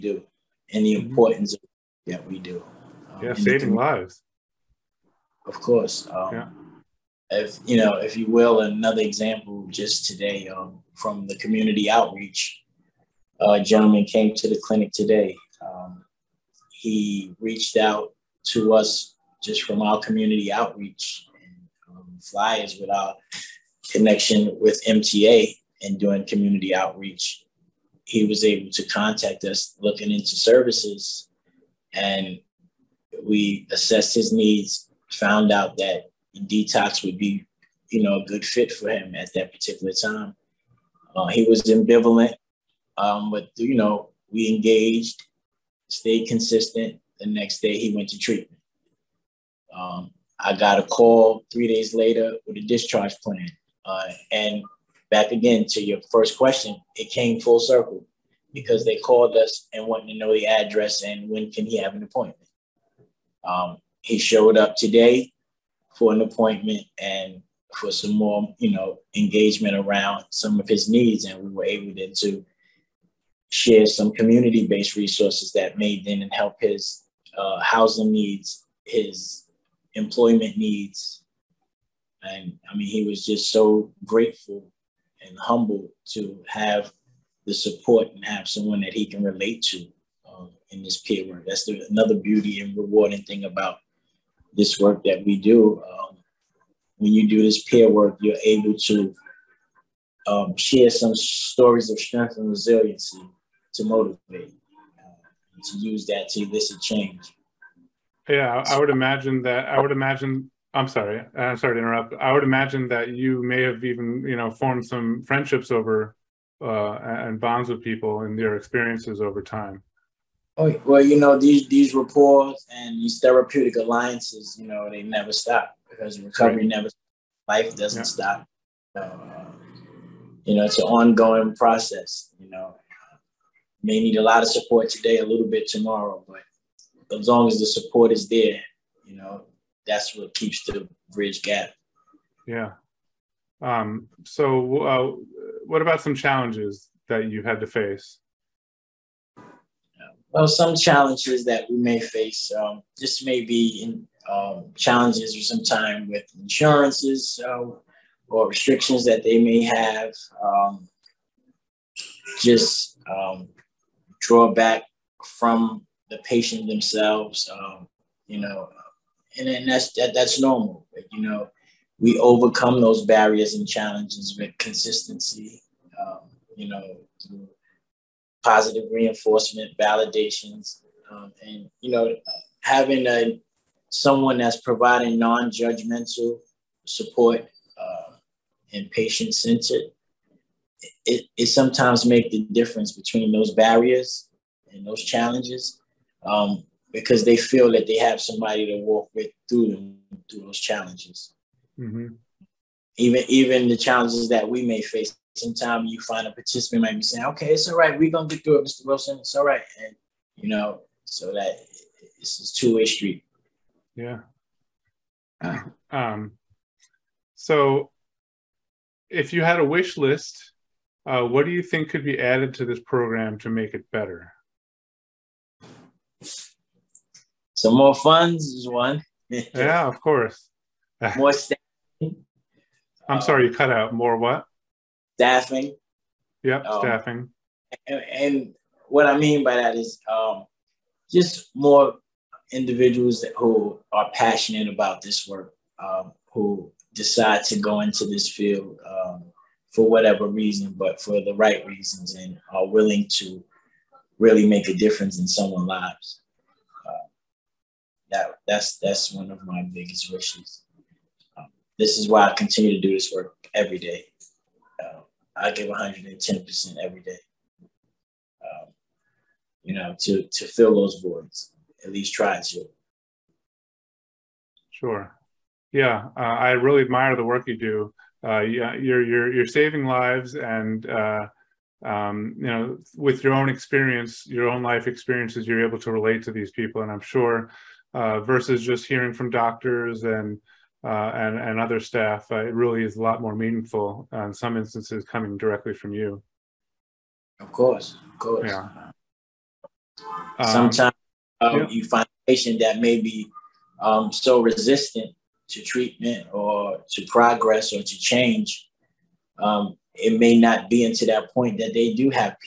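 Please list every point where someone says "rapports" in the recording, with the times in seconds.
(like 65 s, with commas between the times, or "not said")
121 s.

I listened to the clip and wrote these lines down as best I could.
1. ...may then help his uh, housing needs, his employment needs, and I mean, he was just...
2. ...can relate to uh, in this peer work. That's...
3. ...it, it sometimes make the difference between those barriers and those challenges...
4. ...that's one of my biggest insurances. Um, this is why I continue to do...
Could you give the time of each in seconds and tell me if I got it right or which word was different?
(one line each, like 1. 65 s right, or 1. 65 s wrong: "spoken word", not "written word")
1. 75 s right
2. 89 s right
3. 191 s right
4. 258 s wrong: "wishes", not "insurances".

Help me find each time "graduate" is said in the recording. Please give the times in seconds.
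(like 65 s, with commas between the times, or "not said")
not said.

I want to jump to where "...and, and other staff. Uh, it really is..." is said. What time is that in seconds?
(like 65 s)
291 s.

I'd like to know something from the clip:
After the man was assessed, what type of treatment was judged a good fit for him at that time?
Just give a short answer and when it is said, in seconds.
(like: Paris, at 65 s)
Detox, at 36 s.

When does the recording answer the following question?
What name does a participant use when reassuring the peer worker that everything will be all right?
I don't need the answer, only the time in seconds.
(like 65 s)
208 s.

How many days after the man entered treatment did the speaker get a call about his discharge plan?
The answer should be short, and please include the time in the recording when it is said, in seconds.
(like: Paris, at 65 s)
3, at 51 s.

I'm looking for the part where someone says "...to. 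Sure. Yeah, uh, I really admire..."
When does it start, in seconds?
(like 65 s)
272 s.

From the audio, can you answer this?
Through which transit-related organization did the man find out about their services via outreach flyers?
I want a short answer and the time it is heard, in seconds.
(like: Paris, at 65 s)
MTA, at 24 s.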